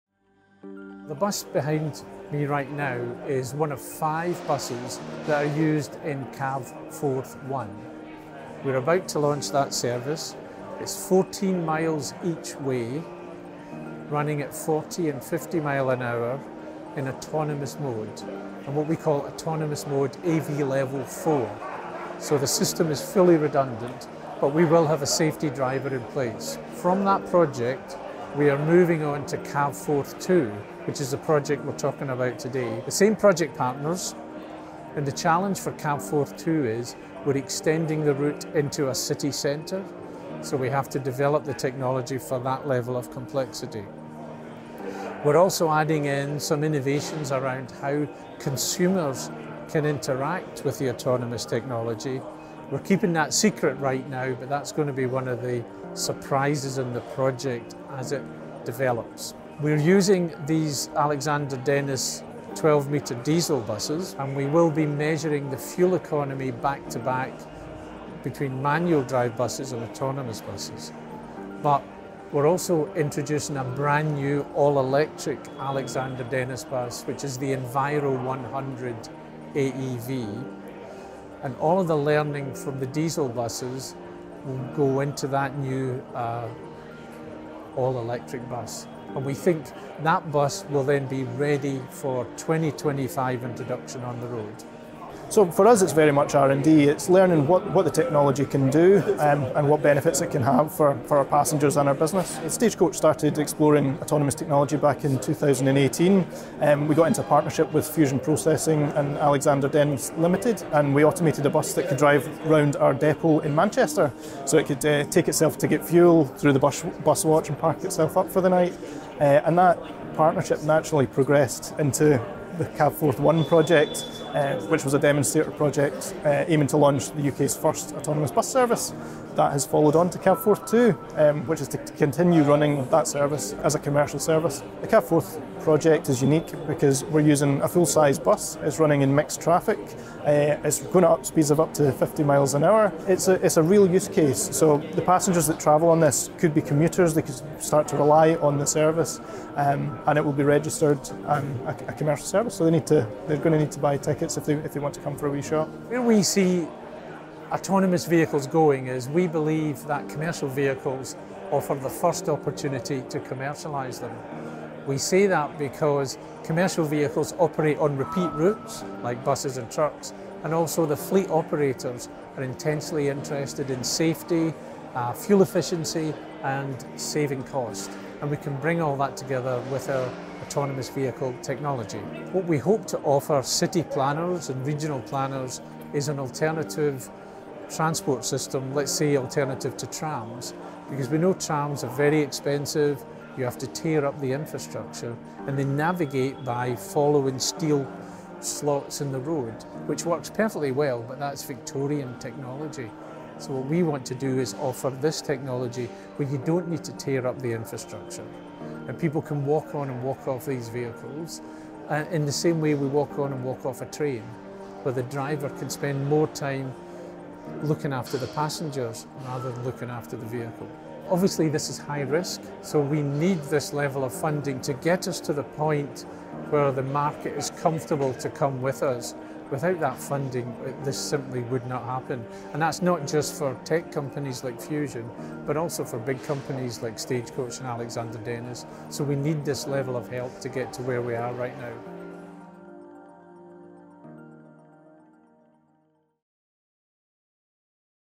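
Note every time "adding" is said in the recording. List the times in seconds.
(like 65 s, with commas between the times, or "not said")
45 s.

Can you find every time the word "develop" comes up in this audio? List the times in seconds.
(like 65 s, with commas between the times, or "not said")
40 s, 58 s.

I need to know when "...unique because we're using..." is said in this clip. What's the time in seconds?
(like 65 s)
136 s.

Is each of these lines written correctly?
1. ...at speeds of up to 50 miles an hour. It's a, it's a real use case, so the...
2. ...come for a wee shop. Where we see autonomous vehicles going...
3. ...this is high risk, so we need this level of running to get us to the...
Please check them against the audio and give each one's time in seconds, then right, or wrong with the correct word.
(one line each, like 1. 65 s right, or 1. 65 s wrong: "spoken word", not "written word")
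1. 141 s right
2. 155 s right
3. 221 s wrong: "funding", not "running".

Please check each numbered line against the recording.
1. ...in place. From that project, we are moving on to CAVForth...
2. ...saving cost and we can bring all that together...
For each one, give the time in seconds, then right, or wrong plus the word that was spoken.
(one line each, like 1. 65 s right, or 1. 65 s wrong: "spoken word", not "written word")
1. 25 s right
2. 176 s right.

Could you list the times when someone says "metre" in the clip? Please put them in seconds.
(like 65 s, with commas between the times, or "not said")
62 s.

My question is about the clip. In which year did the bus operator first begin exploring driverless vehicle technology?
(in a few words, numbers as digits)
2018.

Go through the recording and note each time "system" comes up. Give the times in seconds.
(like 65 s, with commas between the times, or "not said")
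22 s, 188 s.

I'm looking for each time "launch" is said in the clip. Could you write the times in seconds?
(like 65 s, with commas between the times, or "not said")
9 s, 126 s.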